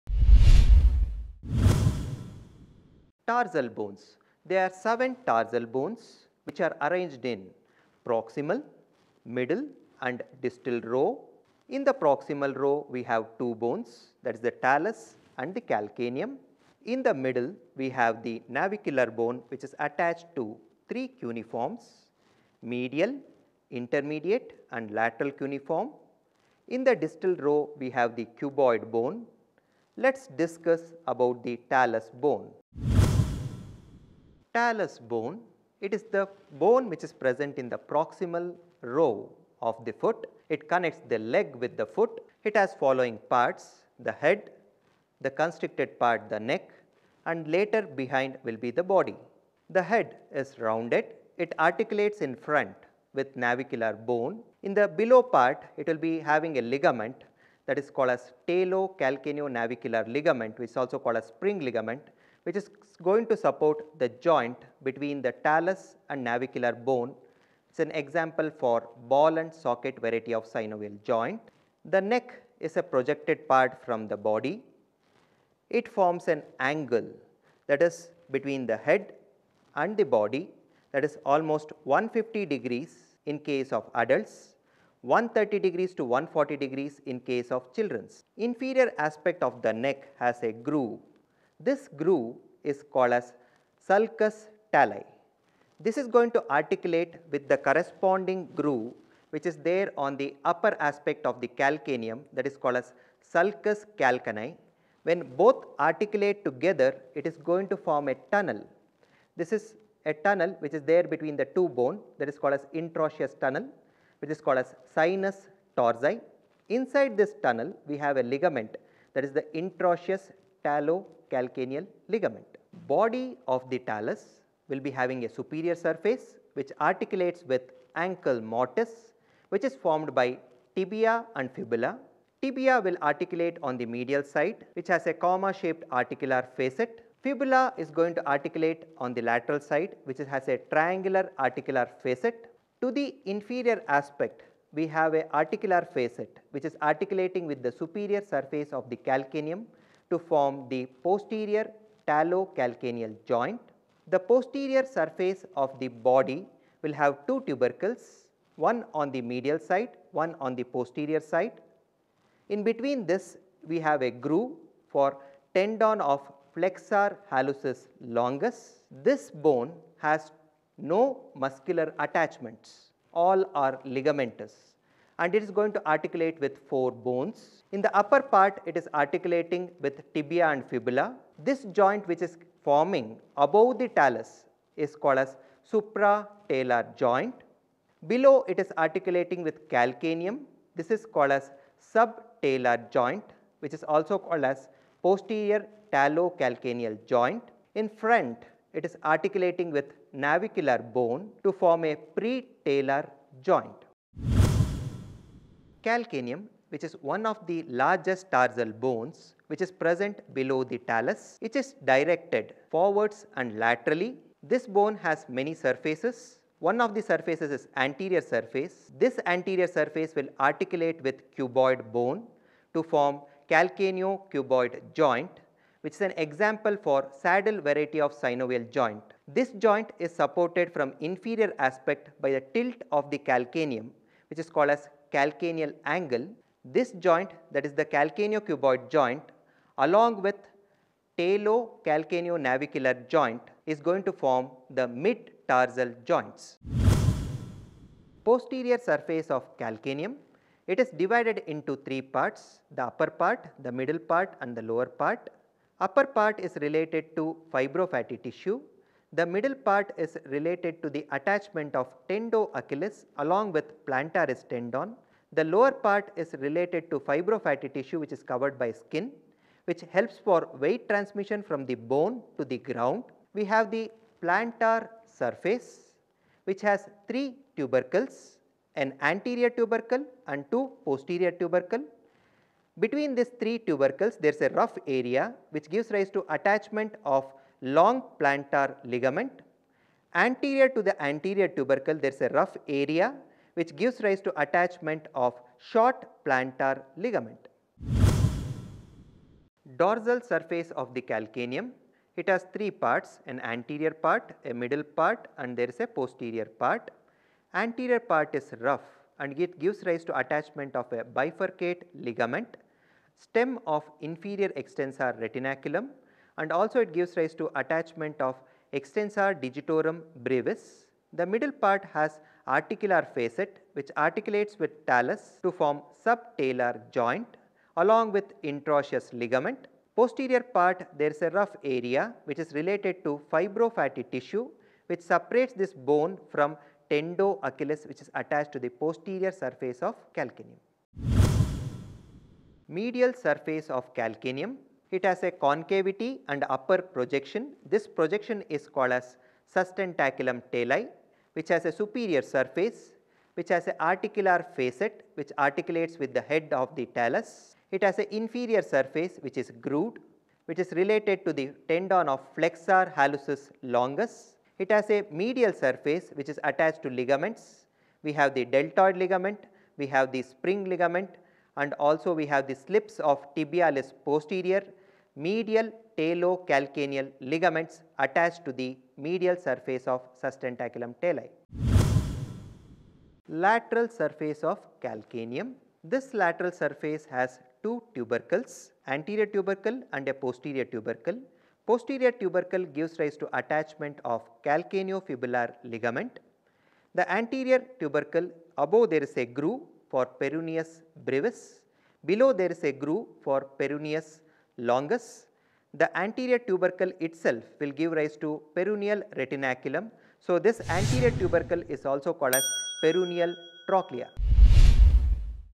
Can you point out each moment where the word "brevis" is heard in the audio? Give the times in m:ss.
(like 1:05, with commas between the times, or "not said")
5:20, 6:41.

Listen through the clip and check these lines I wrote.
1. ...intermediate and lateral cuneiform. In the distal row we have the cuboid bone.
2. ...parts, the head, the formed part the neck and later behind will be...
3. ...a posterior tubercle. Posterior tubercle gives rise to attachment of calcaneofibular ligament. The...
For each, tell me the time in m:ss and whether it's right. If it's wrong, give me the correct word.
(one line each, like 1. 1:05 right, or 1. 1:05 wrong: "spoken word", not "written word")
1. 0:23 right
2. 0:43 wrong: "constricted", not "formed"
3. 6:30 right.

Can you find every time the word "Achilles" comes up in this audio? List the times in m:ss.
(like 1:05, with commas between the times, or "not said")
4:22, 5:36.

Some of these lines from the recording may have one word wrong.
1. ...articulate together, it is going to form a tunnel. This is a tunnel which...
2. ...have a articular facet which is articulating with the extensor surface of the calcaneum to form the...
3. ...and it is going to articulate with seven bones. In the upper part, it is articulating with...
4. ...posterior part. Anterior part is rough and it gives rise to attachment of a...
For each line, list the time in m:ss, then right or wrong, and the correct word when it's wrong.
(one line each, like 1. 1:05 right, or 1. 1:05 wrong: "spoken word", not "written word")
1. 1:45 right
2. 2:24 wrong: "superior", not "extensor"
3. 2:55 wrong: "four", not "seven"
4. 5:05 right.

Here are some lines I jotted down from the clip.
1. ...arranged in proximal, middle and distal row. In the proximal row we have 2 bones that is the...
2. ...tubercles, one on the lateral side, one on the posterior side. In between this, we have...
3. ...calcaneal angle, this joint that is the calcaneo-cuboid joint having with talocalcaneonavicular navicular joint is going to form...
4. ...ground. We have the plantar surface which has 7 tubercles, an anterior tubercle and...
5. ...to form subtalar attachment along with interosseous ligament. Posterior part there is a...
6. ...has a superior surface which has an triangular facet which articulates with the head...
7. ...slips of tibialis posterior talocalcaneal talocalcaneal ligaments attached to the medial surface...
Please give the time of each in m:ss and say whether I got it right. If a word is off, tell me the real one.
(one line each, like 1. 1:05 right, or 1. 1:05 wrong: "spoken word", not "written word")
1. 0:06 right
2. 2:37 wrong: "medial", not "lateral"
3. 3:55 wrong: "along", not "having"
4. 4:32 wrong: "3", not "7"
5. 5:25 wrong: "joint", not "attachment"
6. 5:51 wrong: "articular", not "triangular"
7. 6:12 wrong: "medial", not "talocalcaneal".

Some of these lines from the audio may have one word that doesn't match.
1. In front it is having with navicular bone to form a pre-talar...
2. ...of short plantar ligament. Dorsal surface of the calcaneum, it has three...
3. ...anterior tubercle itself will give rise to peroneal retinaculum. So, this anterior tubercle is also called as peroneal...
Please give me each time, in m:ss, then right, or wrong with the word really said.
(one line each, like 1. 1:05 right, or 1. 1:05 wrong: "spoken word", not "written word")
1. 3:17 wrong: "articulating", not "having"
2. 4:55 right
3. 6:45 right.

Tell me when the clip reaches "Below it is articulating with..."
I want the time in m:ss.
3:08.